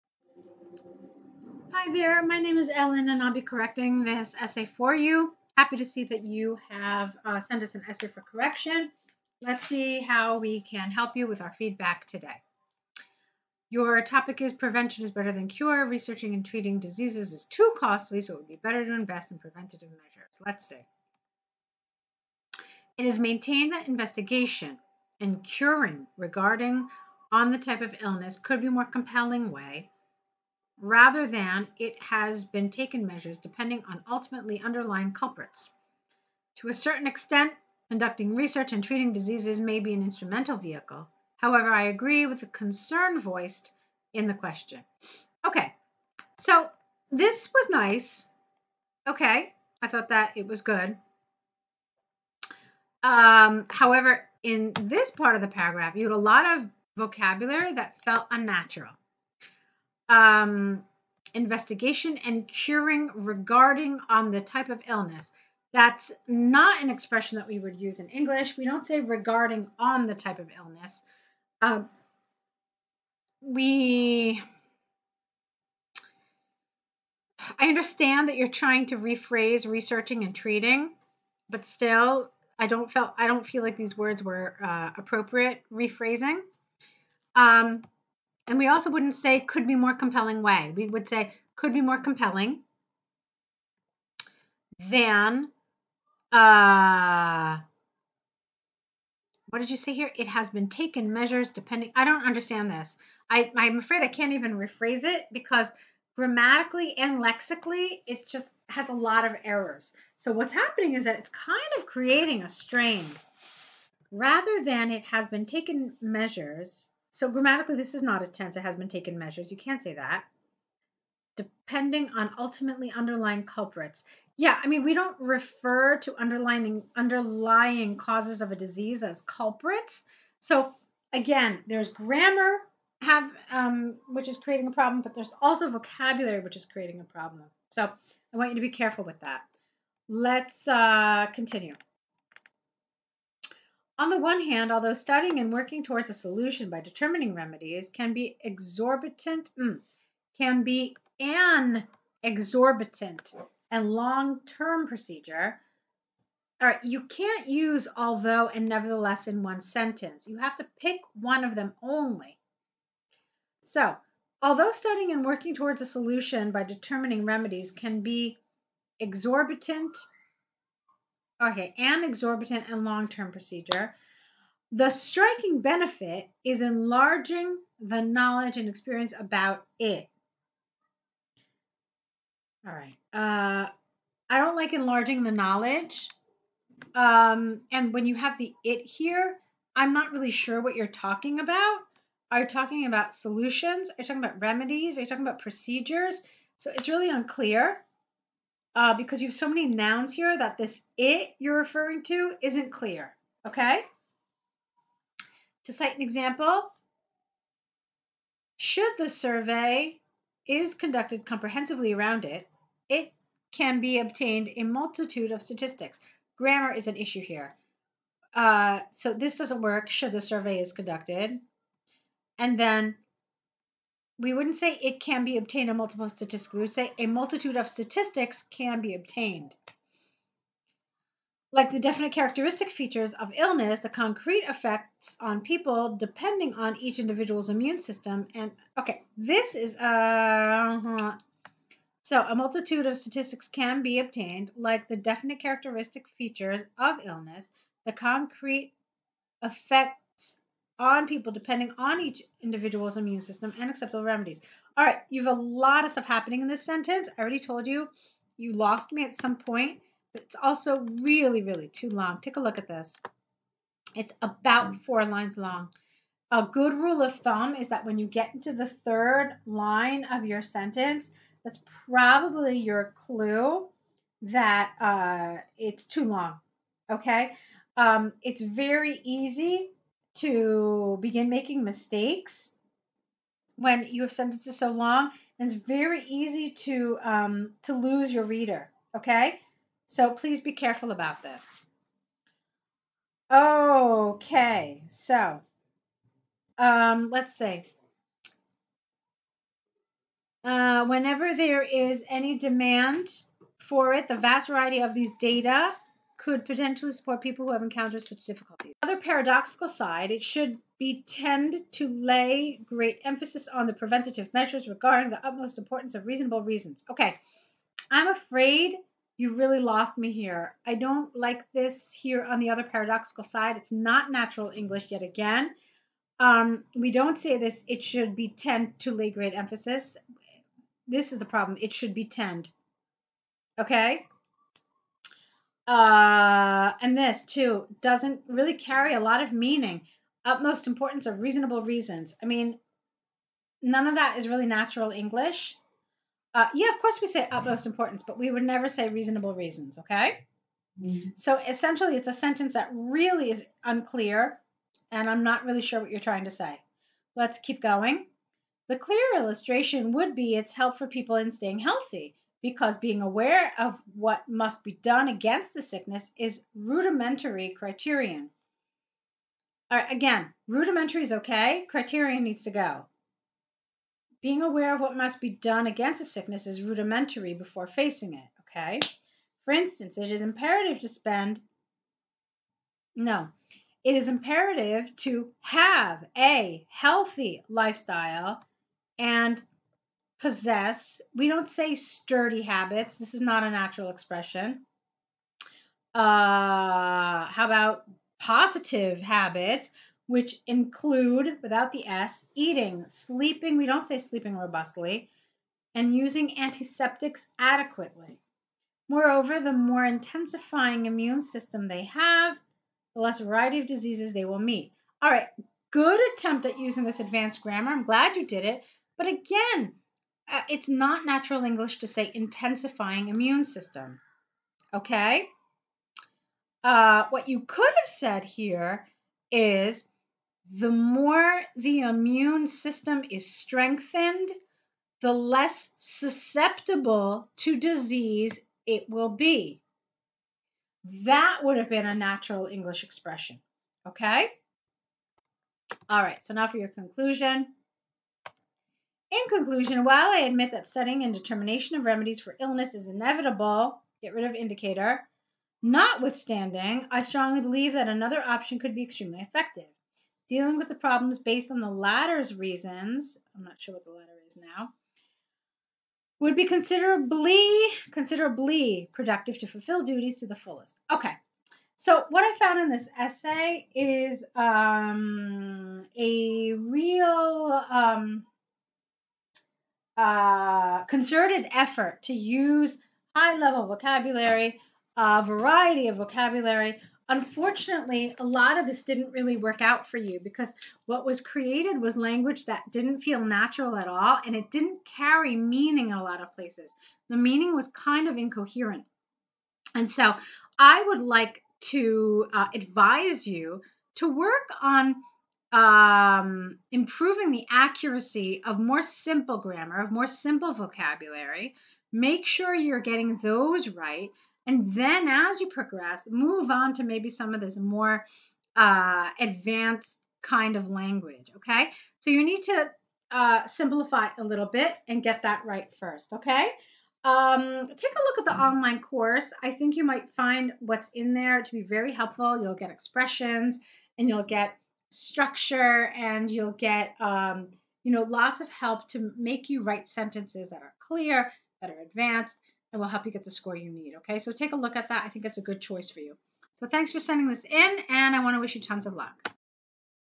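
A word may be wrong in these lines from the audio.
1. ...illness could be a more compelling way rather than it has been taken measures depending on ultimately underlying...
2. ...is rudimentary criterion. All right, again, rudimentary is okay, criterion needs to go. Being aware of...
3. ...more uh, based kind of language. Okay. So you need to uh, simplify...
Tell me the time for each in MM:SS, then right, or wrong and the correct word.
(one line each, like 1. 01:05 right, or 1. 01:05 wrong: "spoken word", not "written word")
1. 00:28 right
2. 06:06 right
3. 08:37 wrong: "advanced", not "based".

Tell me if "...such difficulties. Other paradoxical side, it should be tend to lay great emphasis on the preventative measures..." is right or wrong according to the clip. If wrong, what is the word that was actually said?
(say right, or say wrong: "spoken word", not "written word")
right.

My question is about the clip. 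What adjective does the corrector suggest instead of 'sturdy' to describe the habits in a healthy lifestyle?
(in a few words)
positive.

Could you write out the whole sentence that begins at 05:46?
Uh, yeah, of course we say utmost importance, but we would never say reasonable reasons, okay?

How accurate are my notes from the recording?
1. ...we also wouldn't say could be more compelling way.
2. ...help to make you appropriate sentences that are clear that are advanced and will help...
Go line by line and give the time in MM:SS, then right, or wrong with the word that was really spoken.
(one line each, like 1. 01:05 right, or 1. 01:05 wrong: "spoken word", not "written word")
1. 01:28 right
2. 08:58 wrong: "write", not "appropriate".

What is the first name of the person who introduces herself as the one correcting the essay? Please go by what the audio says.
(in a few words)
Ellen.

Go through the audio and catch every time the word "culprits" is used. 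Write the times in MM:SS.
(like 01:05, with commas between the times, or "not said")
00:35, 02:03, 02:09.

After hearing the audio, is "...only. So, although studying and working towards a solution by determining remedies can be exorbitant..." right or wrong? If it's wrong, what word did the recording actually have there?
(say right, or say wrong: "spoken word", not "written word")
right.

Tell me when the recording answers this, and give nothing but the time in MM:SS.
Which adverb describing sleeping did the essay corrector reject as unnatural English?
06:44.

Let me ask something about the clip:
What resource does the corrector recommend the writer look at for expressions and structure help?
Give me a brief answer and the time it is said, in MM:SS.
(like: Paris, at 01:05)
online course, at 08:48.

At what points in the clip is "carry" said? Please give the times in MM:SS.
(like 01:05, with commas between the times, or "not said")
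05:38, 08:14.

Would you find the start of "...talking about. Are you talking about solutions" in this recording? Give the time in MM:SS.
03:10.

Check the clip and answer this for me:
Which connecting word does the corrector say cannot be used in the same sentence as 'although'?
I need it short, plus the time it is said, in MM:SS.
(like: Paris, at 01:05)
nevertheless, at 02:38.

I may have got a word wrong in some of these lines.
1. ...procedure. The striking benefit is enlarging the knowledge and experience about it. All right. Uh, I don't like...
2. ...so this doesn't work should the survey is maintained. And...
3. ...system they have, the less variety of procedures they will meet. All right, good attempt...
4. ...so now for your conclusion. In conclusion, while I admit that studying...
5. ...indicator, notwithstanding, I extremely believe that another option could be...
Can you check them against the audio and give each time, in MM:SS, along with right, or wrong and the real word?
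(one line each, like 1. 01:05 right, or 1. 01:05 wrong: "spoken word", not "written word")
1. 02:53 right
2. 03:38 wrong: "conducted", not "maintained"
3. 06:51 wrong: "diseases", not "procedures"
4. 07:26 right
5. 07:34 wrong: "strongly", not "extremely".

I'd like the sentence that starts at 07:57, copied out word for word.
Um, uh, concerted effort to use high level vocabulary, a variety of vocabulary.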